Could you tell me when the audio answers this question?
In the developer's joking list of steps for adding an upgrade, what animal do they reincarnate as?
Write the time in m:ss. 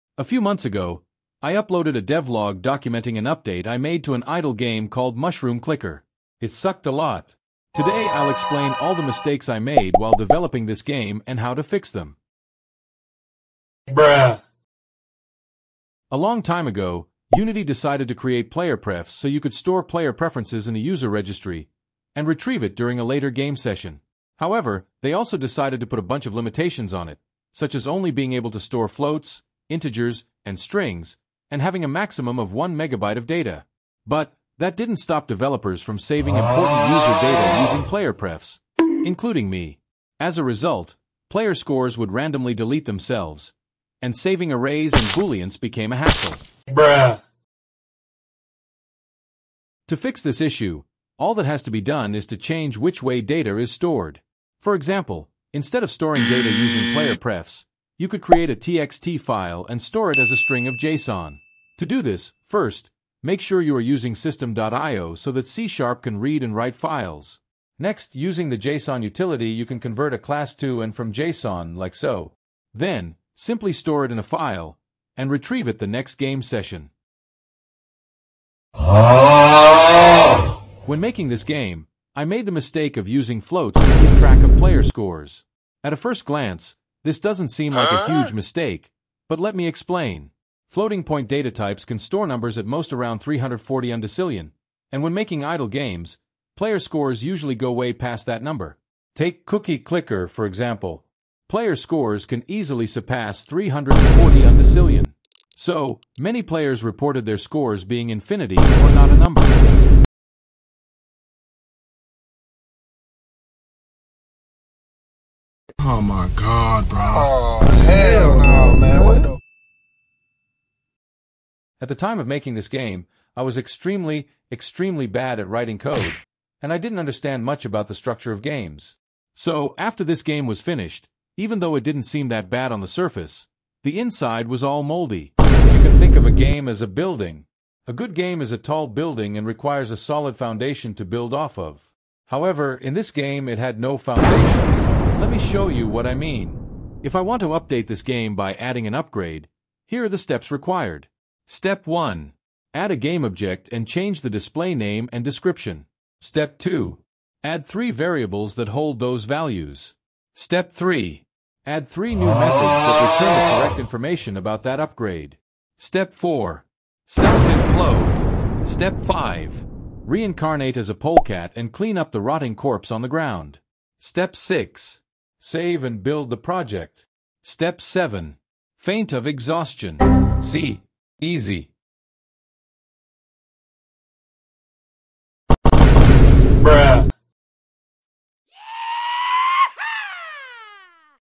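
2:50.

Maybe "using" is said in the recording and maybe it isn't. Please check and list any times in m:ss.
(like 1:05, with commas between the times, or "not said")
0:37, 0:56, 1:03, 1:08, 1:23.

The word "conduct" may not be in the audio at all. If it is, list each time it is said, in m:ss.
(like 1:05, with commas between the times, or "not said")
not said.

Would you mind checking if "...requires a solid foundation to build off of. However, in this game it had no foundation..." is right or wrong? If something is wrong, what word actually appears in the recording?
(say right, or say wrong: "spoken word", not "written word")
right.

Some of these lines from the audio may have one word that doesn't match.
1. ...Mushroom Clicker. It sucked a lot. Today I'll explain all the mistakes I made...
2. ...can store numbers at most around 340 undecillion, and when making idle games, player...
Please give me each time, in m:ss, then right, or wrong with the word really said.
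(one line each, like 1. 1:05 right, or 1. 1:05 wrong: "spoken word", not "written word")
1. 0:05 right
2. 1:31 right.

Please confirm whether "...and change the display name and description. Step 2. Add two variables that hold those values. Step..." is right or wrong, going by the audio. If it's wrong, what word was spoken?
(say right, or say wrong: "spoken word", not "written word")
wrong: "three", not "two".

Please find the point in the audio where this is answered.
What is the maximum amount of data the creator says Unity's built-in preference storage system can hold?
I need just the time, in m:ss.
0:32.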